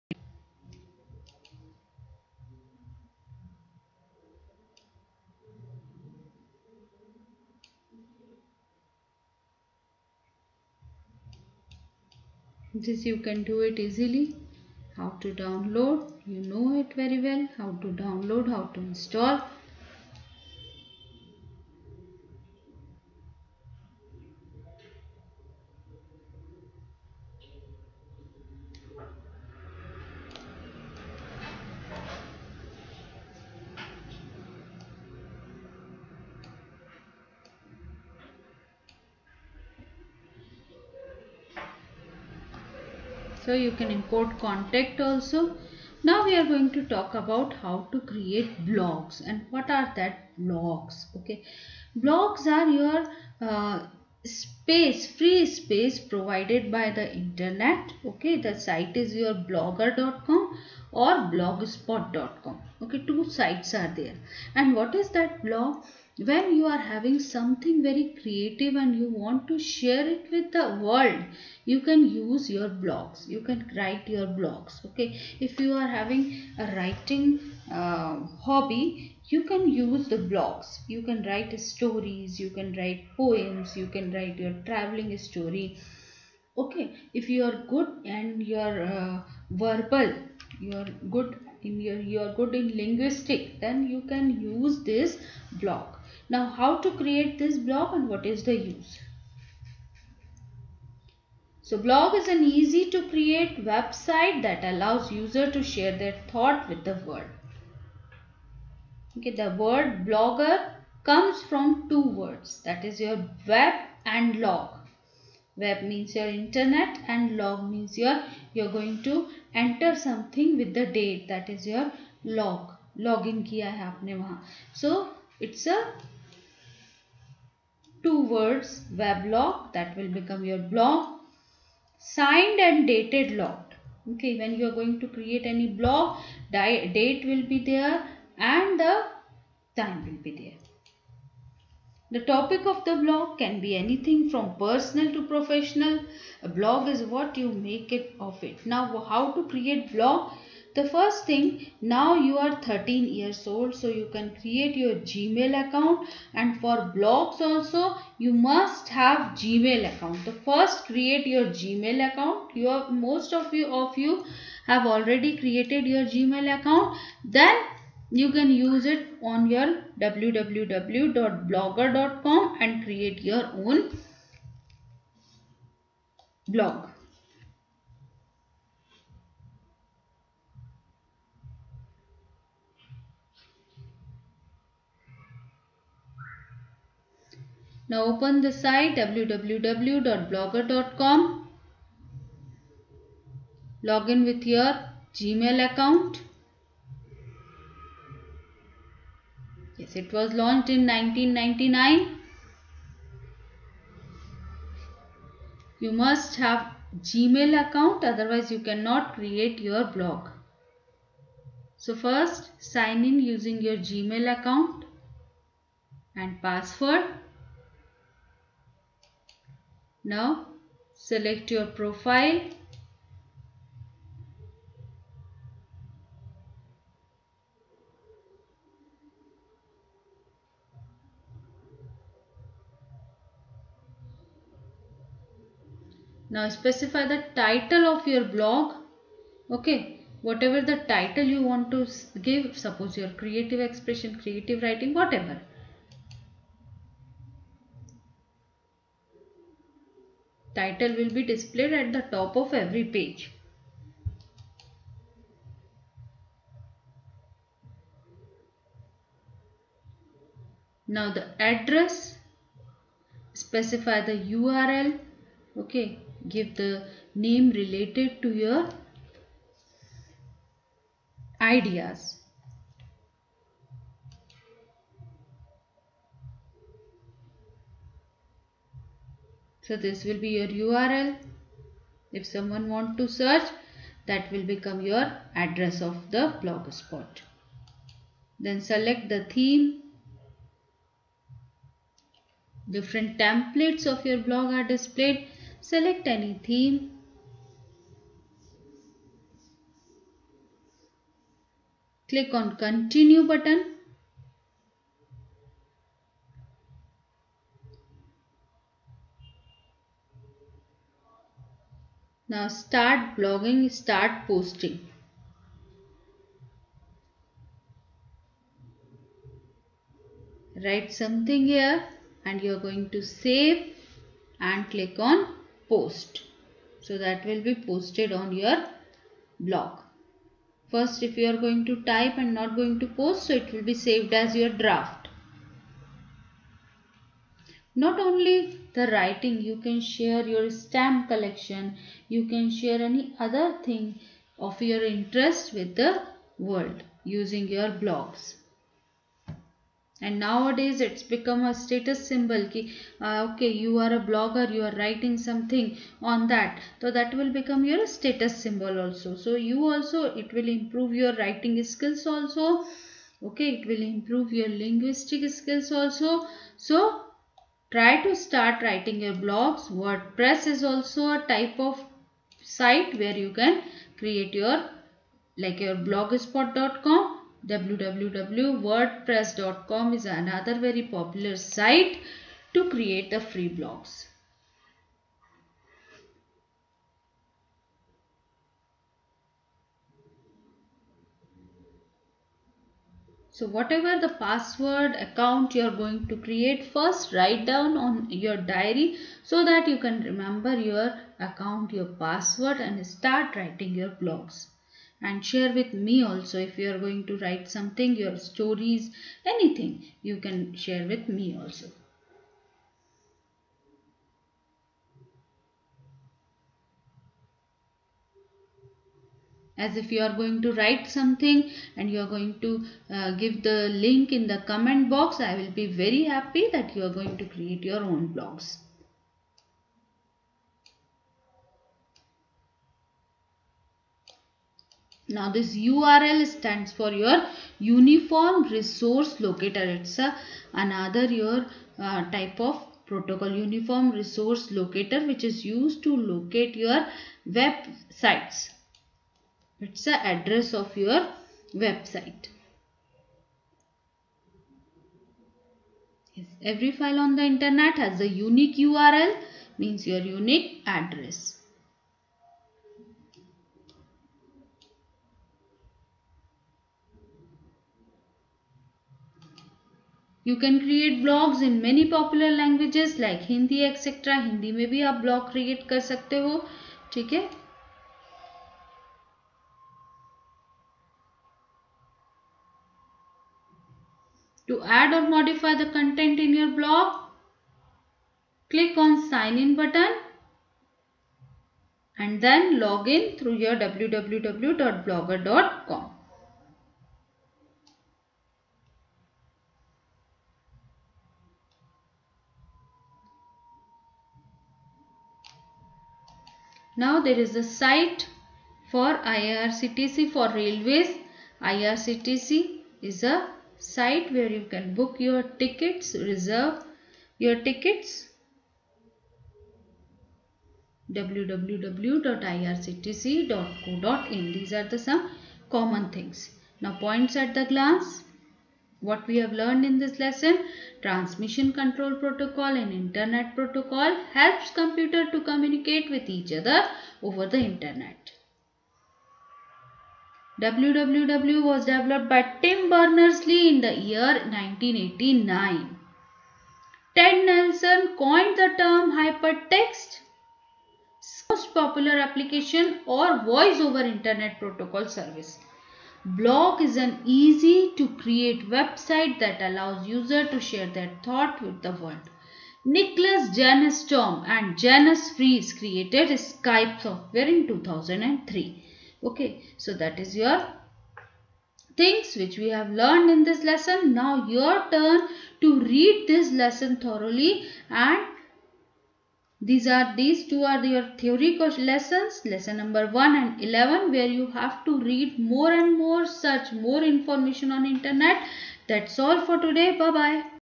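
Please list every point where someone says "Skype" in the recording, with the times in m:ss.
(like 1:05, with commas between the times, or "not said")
9:26.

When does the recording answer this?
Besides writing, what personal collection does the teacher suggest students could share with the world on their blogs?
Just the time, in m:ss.
5:40.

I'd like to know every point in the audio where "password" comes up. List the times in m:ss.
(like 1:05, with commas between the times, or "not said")
3:36, 6:34, 6:41.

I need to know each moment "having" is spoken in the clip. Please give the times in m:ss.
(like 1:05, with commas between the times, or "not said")
1:06, 1:15.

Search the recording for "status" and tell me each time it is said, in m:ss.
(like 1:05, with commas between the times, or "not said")
5:51, 5:57.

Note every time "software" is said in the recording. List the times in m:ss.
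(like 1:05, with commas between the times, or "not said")
9:26.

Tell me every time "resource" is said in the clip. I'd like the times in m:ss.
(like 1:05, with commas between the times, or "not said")
7:18, 7:23.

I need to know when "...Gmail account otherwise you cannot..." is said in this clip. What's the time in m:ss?
3:26.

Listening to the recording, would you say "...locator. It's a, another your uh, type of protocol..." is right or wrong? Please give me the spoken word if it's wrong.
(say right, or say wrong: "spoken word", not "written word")
right.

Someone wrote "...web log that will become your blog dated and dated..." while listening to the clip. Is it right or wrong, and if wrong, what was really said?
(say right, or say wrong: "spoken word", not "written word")
wrong: "signed", not "dated".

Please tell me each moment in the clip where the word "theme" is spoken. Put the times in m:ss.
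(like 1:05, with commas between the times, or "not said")
4:49, 4:56.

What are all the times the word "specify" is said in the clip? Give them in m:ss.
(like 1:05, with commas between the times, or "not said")
3:56, 4:23.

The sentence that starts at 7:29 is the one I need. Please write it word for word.
It's the address of your website.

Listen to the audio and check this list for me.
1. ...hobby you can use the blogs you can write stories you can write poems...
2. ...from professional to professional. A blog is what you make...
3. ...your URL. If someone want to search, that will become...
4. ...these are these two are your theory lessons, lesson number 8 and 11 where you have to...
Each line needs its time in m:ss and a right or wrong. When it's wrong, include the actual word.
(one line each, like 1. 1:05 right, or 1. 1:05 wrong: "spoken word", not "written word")
1. 1:18 right
2. 2:24 wrong: "personal", not "professional"
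3. 4:40 right
4. 9:39 wrong: "1", not "8".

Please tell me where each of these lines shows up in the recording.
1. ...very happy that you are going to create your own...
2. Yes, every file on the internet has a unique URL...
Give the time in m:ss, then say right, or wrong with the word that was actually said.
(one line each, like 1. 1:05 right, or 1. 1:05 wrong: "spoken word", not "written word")
1. 7:05 right
2. 7:36 right.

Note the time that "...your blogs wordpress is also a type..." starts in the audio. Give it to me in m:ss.
6:09.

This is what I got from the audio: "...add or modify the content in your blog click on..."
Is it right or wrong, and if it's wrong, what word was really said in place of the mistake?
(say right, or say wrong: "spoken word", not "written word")
right.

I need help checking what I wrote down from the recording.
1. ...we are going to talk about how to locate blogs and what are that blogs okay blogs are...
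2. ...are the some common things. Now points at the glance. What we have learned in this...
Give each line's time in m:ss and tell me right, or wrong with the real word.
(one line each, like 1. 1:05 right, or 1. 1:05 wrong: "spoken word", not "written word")
1. 0:46 wrong: "create", not "locate"
2. 8:44 right.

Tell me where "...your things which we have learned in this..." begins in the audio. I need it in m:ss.
9:30.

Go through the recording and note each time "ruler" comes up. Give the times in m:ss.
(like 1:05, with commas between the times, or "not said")
not said.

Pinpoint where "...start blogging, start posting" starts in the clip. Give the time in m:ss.
5:12.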